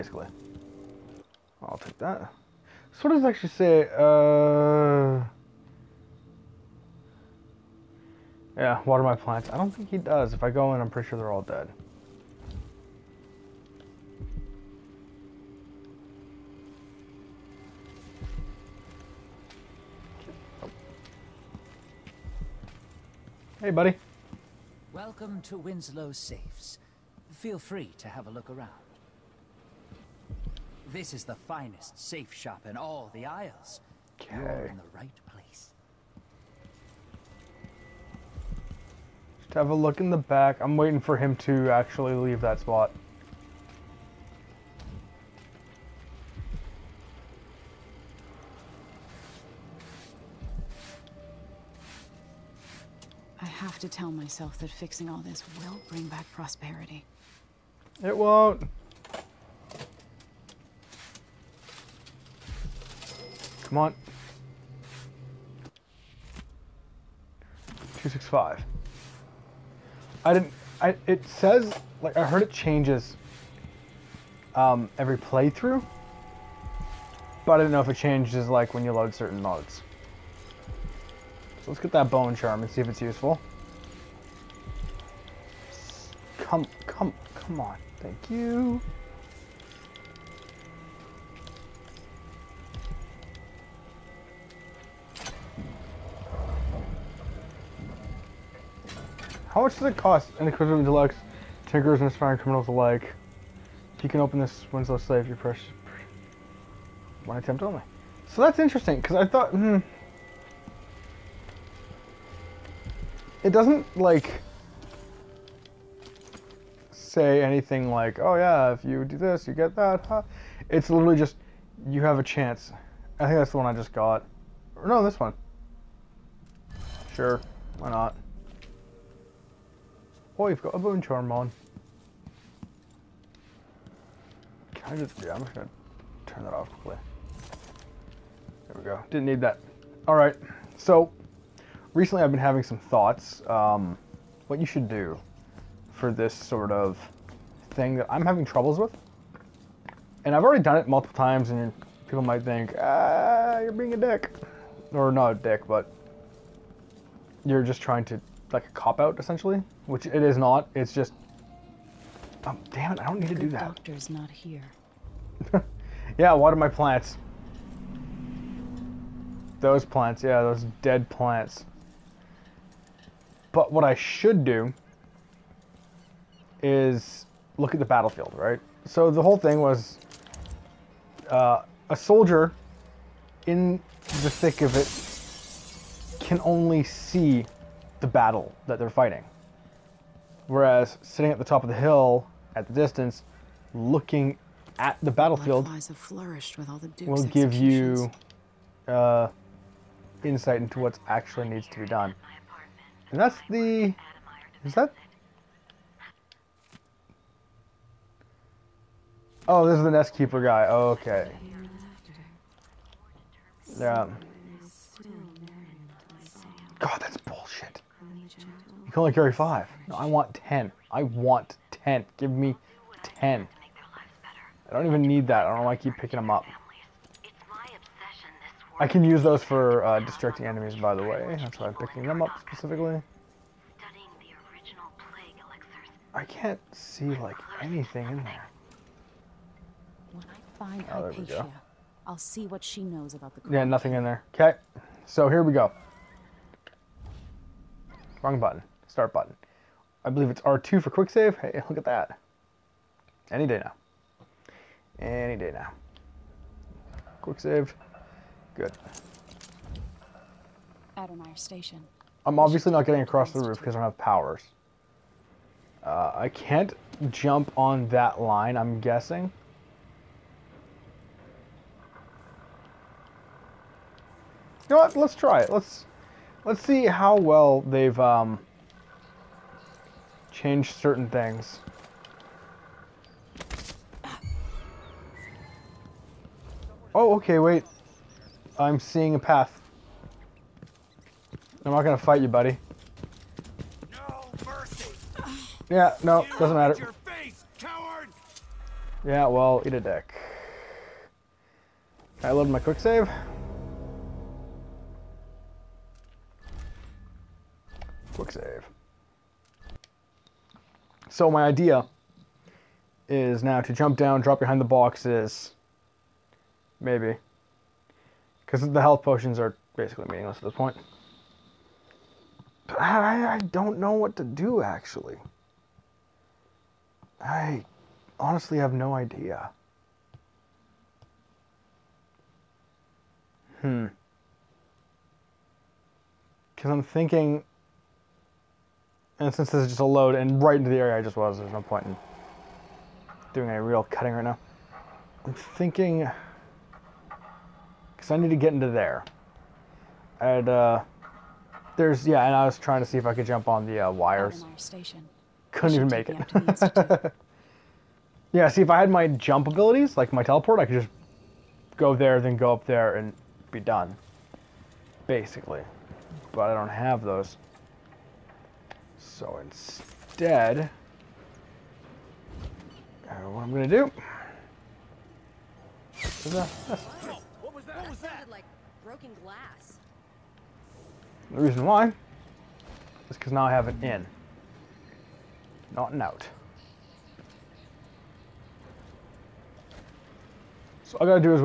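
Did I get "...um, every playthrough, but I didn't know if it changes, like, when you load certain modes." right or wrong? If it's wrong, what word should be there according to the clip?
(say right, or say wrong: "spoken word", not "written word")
right.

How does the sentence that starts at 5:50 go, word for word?
And uh, there's, yeah, and I was trying to see if I could jump on the uh, wires.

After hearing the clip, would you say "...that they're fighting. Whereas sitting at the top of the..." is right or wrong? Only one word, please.
right.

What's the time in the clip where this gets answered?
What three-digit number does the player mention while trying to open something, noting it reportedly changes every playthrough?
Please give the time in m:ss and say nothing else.
1:08.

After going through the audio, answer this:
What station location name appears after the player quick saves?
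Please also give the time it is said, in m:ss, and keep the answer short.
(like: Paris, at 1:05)
Addermire Station, at 4:20.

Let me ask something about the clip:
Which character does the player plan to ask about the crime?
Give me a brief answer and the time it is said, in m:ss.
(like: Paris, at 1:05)
Hypatia, at 4:01.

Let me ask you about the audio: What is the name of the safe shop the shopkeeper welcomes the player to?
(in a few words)
Winslow Safes.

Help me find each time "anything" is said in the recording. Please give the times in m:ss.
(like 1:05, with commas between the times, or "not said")
1:57, 3:57.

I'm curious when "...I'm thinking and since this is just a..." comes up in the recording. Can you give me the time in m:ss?
5:36.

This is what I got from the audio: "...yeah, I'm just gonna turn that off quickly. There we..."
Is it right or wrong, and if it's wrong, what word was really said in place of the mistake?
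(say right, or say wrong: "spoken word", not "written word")
right.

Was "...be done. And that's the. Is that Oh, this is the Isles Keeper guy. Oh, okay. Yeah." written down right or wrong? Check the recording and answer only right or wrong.
wrong.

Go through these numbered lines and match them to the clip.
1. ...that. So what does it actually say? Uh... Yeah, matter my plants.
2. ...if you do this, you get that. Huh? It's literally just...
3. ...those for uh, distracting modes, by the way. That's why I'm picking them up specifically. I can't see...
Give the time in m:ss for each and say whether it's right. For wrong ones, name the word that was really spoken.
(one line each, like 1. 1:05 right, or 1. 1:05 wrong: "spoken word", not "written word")
1. 0:01 wrong: "water", not "matter"
2. 1:58 right
3. 3:49 wrong: "enemies", not "modes".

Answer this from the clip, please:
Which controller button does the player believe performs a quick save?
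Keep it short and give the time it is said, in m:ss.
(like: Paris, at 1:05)
R2, at 4:10.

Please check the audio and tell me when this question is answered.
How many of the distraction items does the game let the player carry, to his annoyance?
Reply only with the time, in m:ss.
3:39.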